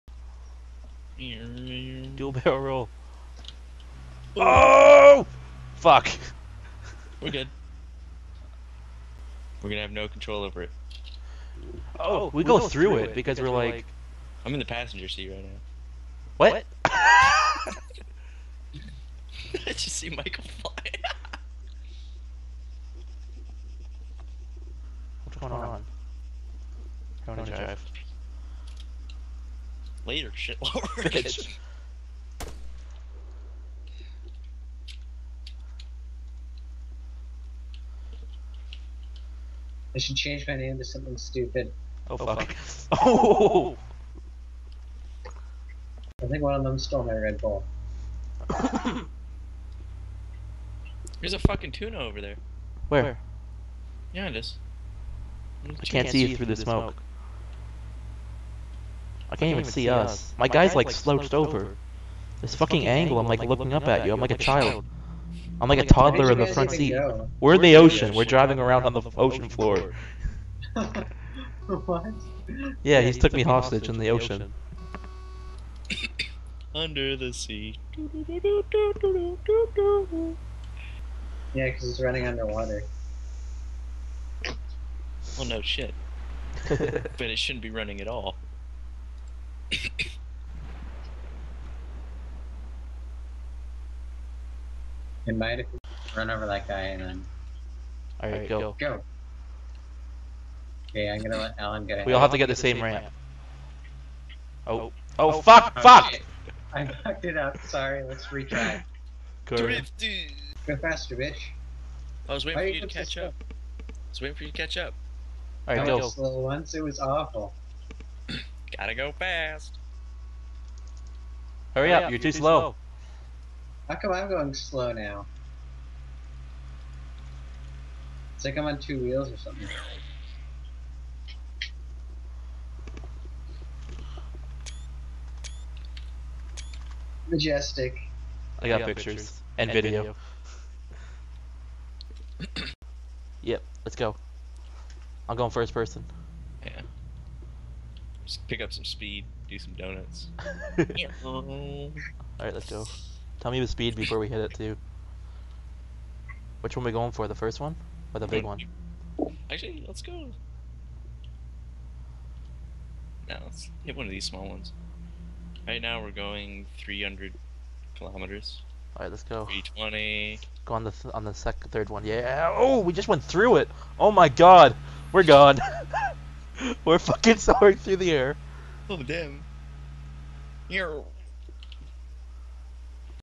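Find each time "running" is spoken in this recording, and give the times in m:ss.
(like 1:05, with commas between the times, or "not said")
1:22, 1:27.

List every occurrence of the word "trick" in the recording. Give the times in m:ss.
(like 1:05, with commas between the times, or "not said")
not said.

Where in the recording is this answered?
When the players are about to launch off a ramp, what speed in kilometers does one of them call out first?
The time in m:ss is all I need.
2:46.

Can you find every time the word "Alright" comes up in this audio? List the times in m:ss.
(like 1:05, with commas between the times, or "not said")
1:38, 1:55.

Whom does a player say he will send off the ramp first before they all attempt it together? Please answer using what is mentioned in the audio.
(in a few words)
Alan.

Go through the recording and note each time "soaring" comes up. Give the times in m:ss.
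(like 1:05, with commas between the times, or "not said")
2:57.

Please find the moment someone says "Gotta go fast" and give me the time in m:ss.
1:58.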